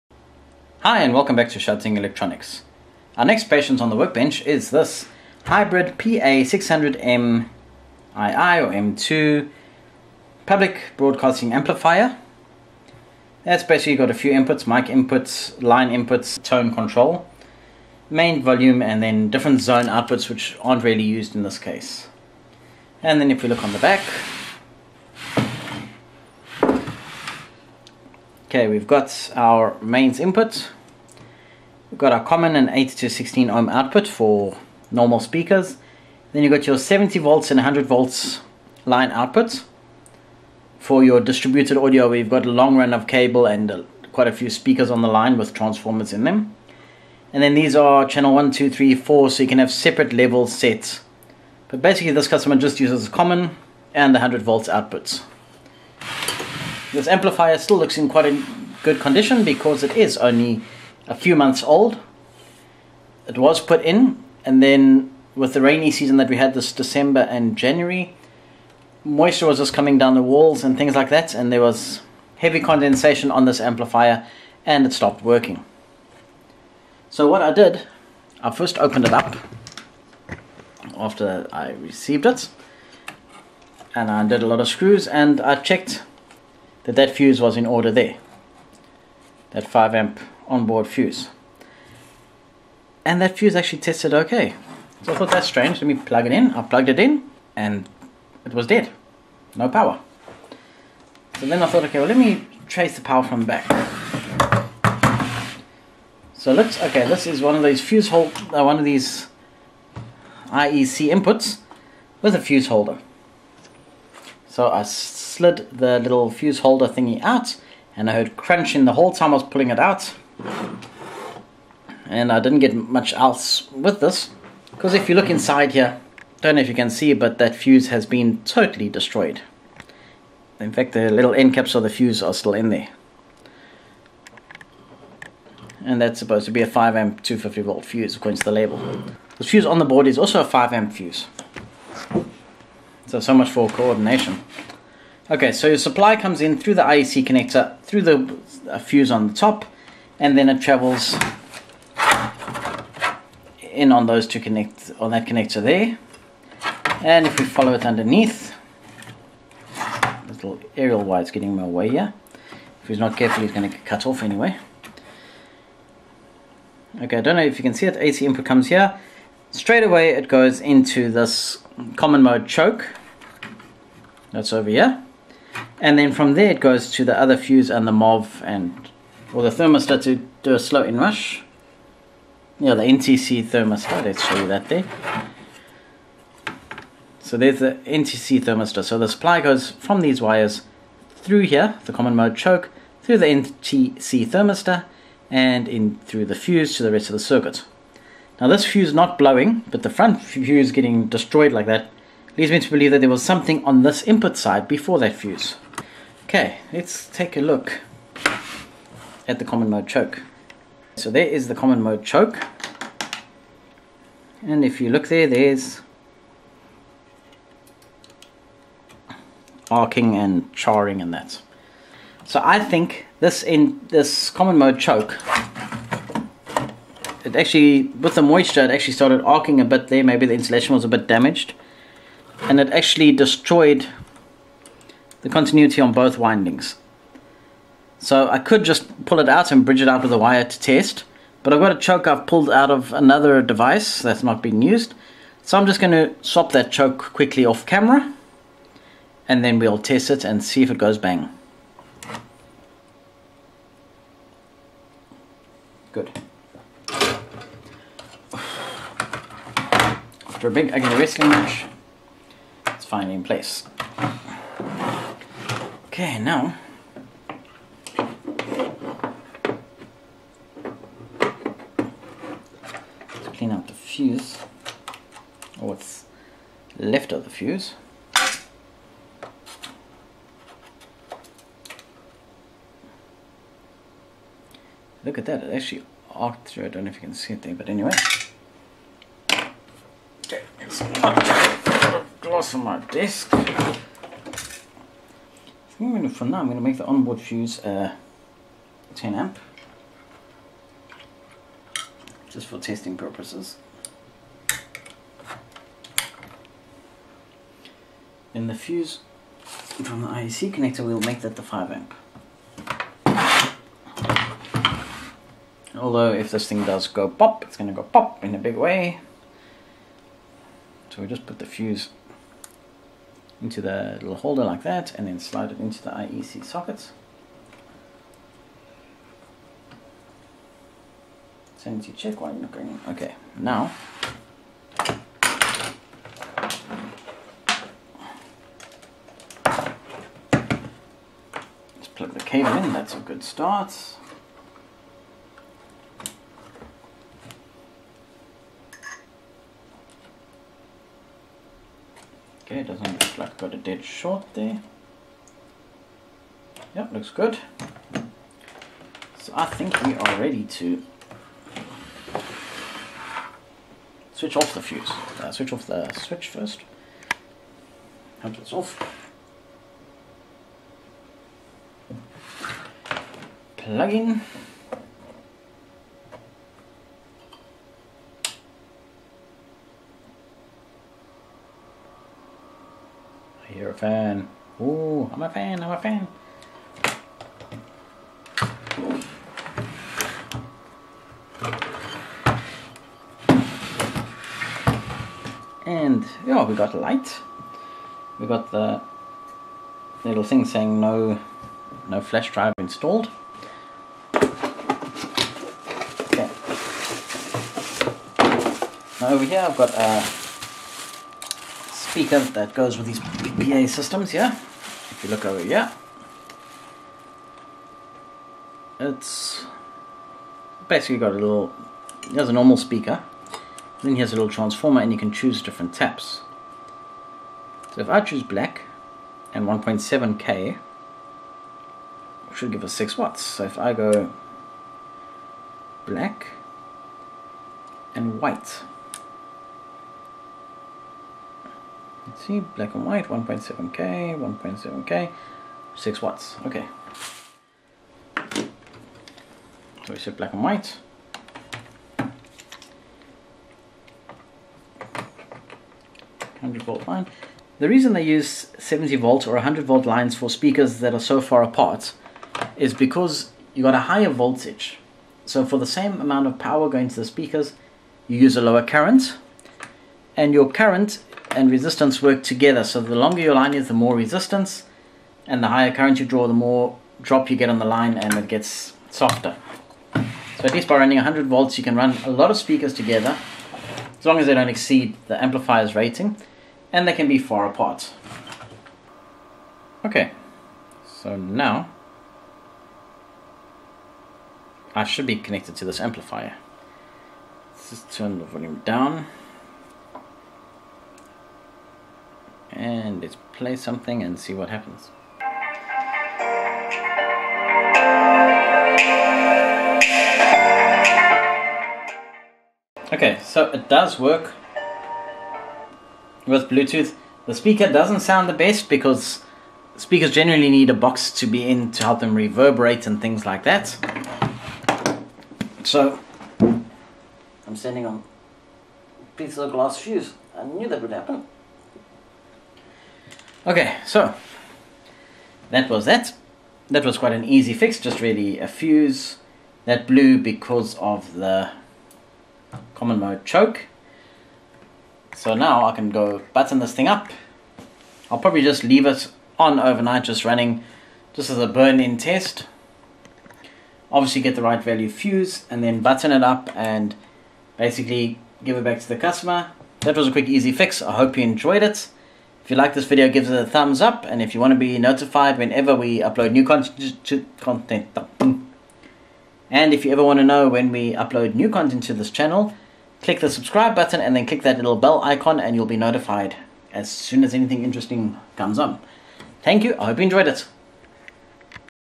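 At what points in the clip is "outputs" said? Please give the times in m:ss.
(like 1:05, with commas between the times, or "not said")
0:19, 0:33, 0:39, 0:54.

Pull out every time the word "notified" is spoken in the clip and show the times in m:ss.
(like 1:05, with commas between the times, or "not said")
9:24, 9:35.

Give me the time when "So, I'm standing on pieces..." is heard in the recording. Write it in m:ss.
8:45.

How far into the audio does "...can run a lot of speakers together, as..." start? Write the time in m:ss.
8:01.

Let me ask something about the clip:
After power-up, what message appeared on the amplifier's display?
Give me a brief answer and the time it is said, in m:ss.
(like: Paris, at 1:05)
no flash drive installed, at 6:41.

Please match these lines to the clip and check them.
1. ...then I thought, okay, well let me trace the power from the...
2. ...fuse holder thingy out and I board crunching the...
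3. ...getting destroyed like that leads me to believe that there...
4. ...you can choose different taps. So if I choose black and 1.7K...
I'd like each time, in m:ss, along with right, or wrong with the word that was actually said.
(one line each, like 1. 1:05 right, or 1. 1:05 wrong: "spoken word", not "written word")
1. 1:41 right
2. 1:56 wrong: "heard", not "board"
3. 3:20 right
4. 7:04 right.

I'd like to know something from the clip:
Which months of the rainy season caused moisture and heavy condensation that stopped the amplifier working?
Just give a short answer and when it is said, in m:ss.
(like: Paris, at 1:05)
December and January, at 1:06.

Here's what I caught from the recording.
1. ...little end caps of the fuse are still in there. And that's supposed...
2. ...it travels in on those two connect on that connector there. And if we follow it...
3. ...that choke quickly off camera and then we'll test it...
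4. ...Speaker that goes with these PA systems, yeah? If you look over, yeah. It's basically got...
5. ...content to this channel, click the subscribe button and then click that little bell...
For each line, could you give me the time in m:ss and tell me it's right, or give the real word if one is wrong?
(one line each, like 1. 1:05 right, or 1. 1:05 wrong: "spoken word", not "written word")
1. 2:11 right
2. 2:30 right
3. 4:06 right
4. 6:51 right
5. 9:31 right.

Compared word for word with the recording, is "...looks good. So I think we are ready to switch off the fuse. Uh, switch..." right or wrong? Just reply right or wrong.
right.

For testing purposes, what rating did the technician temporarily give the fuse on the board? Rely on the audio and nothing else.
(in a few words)
10 amp.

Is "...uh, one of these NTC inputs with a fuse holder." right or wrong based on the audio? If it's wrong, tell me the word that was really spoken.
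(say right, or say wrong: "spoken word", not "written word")
wrong: "IEC", not "NTC".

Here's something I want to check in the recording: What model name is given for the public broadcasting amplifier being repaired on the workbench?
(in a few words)
PA600M II.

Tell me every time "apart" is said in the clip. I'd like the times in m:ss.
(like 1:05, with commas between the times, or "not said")
7:41, 8:07.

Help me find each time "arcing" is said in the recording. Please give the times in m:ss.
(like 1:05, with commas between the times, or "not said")
3:39, 3:49.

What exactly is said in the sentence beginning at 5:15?
Although if this thing does go pop, it's going to go pop in a big way.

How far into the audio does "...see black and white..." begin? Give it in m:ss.
7:22.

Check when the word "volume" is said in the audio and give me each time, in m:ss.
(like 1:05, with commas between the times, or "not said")
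0:18, 8:18.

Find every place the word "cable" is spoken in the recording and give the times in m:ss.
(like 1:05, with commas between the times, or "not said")
0:43, 5:42.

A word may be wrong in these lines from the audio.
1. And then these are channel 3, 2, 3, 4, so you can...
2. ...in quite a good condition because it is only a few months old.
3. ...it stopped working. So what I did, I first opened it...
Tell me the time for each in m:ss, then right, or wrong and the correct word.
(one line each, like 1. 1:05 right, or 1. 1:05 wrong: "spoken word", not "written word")
1. 0:47 wrong: "1", not "3"
2. 0:57 right
3. 1:14 right.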